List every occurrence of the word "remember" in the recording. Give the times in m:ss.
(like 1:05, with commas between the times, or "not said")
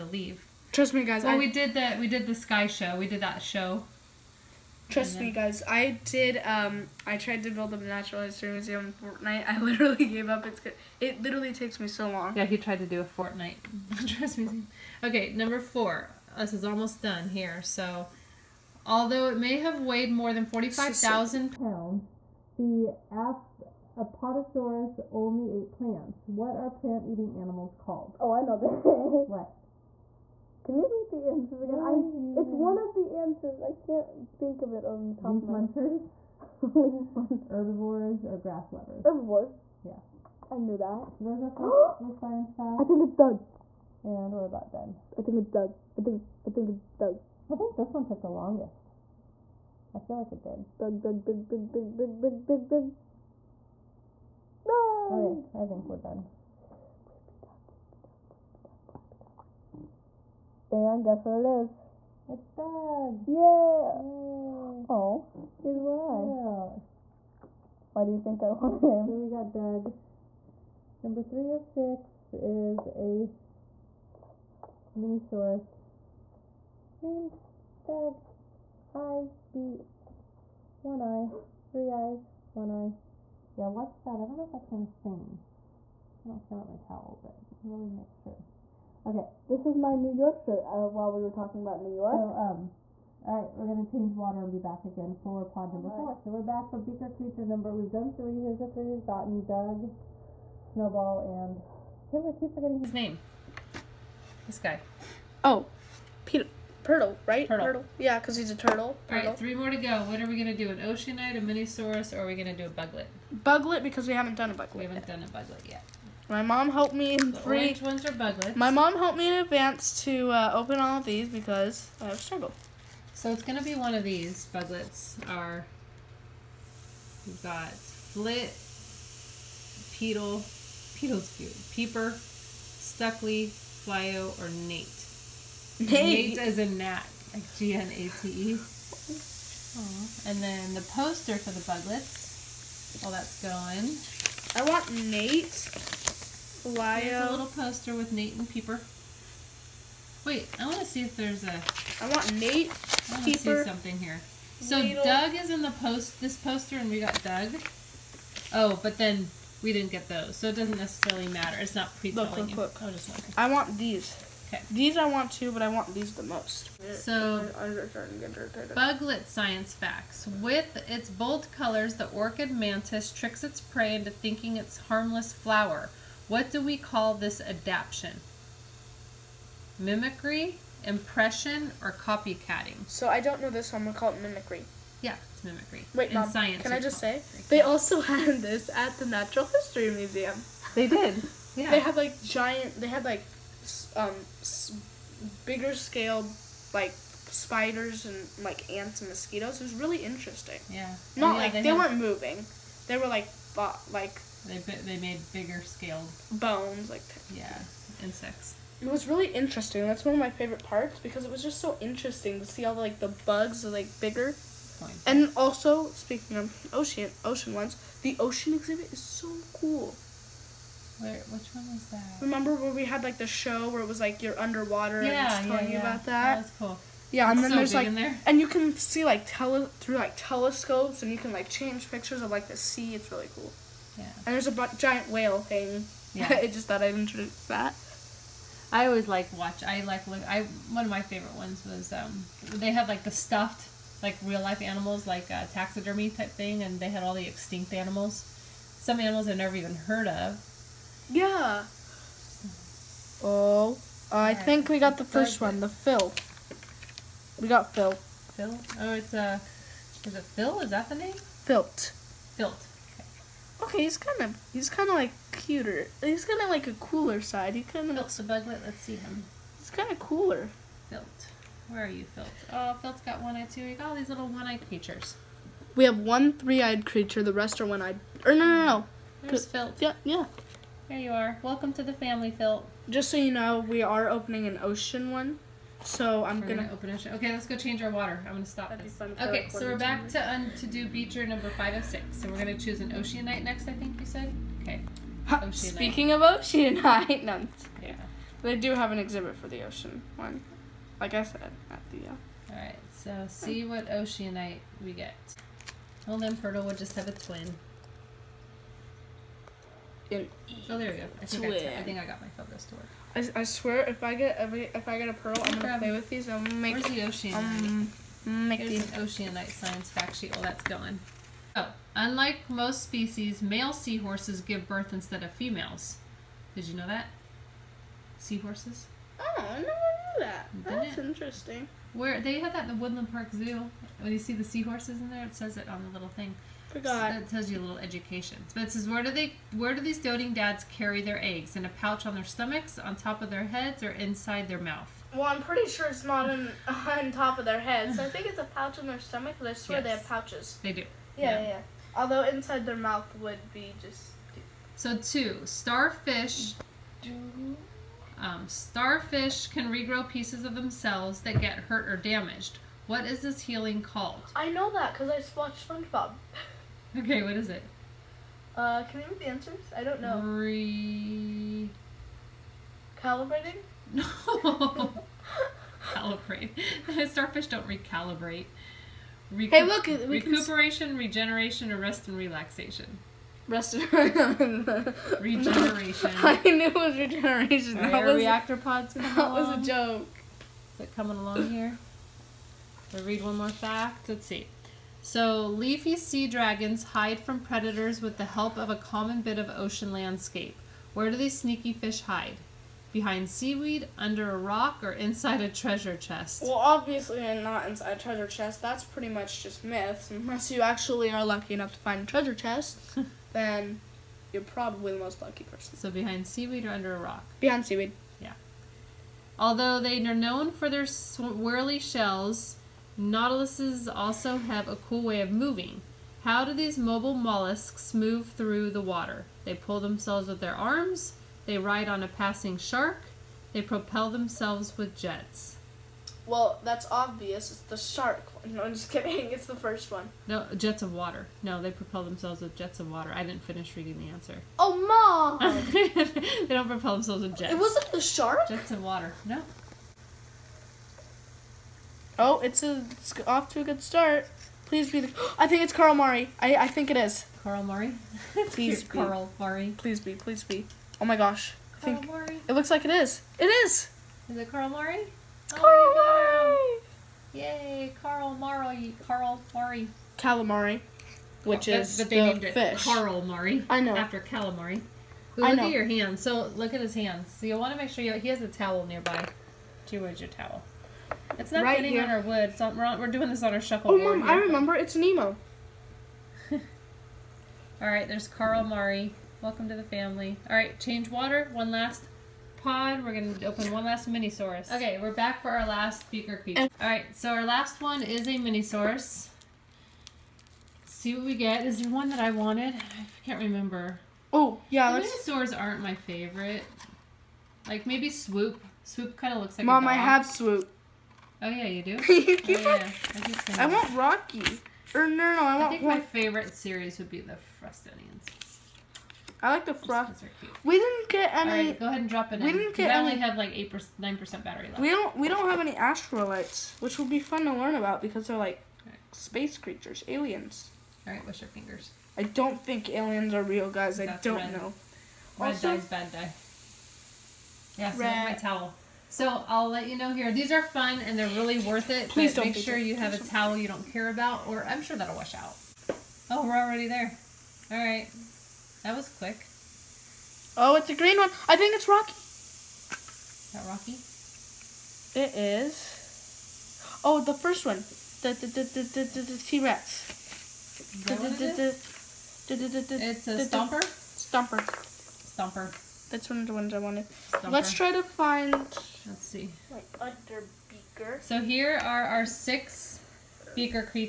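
3:42, 8:04, 8:23.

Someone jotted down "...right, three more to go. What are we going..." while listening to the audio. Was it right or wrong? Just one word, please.
right.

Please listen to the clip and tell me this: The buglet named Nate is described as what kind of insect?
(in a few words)
A gnat.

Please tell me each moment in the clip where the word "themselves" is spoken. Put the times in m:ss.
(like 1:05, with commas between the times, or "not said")
6:00, 7:09, 7:14, 7:22, 7:26.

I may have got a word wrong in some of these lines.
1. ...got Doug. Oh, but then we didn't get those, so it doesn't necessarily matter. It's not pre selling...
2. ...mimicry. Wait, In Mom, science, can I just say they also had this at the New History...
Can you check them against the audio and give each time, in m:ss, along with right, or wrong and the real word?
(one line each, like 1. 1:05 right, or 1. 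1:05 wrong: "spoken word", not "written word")
1. 2:36 right
2. 3:05 wrong: "Natural", not "New".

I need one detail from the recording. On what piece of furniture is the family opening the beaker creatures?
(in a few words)
Shuffleboard.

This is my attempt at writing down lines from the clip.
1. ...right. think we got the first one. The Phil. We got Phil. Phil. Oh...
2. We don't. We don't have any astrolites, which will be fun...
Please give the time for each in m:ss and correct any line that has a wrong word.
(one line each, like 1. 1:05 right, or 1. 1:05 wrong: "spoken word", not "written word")
1. 4:14 right
2. 8:44 right.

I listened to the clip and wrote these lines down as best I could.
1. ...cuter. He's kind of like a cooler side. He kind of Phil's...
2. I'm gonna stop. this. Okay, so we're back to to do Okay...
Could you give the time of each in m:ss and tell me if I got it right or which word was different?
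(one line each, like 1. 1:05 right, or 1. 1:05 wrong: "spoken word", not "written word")
1. 4:25 right
2. 4:48 wrong: "Beaker", not "Okay".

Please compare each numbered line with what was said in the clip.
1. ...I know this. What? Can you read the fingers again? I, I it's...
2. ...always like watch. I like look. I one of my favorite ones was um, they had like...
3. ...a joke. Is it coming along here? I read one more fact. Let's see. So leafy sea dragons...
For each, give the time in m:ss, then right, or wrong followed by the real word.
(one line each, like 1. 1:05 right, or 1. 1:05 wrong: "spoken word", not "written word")
1. 0:28 wrong: "answers", not "fingers"
2. 3:58 right
3. 6:29 right.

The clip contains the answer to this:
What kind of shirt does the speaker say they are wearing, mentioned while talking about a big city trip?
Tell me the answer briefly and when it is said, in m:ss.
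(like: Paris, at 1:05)
New York shirt, at 1:29.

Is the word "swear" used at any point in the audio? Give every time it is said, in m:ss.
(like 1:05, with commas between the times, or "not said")
5:13, 5:49.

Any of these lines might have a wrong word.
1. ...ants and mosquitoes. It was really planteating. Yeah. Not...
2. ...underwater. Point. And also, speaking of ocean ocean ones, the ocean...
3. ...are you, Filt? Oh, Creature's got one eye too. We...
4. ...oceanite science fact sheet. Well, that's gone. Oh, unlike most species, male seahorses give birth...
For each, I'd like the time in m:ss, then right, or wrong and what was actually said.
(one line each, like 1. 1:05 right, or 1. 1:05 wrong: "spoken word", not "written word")
1. 3:18 wrong: "interesting", not "planteating"
2. 3:33 wrong: "bigger", not "underwater"
3. 4:31 wrong: "Filt", not "Creature"
4. 5:19 right.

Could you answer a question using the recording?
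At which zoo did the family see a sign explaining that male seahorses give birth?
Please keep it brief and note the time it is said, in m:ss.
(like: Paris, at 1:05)
Woodland Park Zoo, at 5:32.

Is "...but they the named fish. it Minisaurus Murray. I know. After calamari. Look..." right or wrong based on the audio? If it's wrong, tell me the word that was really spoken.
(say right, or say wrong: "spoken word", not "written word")
wrong: "Carl", not "Minisaurus".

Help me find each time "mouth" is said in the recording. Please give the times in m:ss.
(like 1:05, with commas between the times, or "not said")
5:44, 5:52.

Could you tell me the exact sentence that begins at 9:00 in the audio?
These are fun and they're really worth it.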